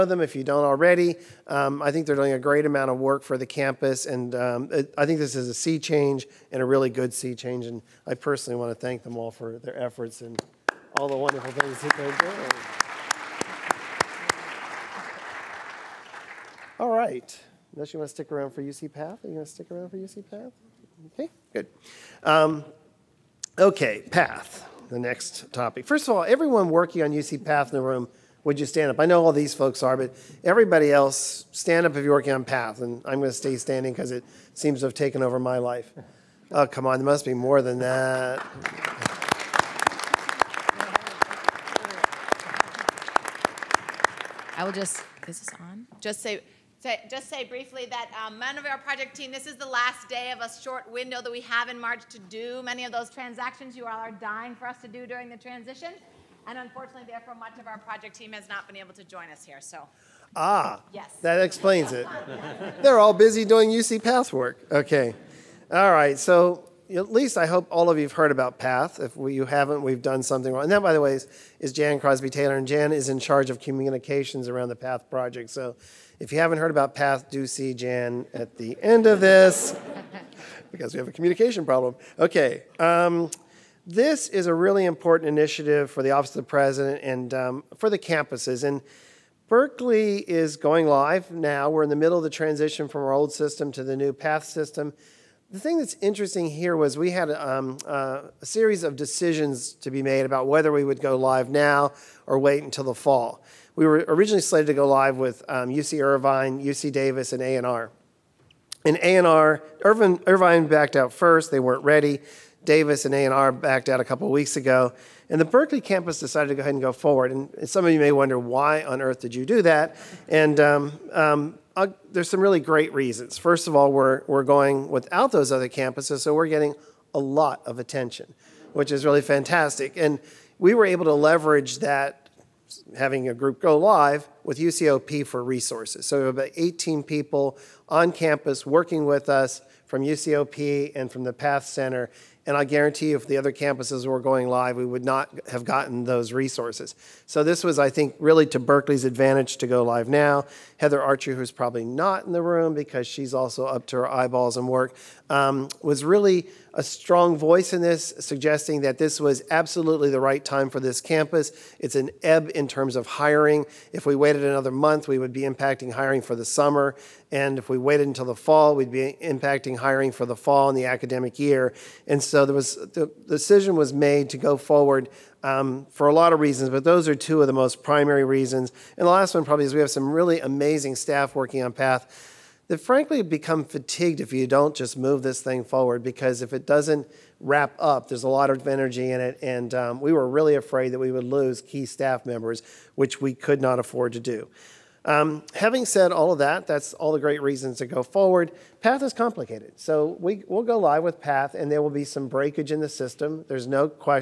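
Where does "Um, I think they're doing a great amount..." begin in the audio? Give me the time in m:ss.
0:01.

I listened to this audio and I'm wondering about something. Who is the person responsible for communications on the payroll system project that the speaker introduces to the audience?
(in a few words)
Jan Crosby Taylor.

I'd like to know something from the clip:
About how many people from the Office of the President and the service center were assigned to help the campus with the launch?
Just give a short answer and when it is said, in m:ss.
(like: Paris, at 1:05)
18, at 2:16.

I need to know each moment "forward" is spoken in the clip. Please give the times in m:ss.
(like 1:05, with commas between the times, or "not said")
1:56, 2:54, 3:05, 3:18.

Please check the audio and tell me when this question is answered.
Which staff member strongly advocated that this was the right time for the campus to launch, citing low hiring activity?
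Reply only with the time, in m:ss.
2:30.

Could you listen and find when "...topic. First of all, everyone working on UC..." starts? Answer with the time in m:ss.
0:25.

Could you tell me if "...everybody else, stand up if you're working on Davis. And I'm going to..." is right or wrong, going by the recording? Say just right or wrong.
wrong.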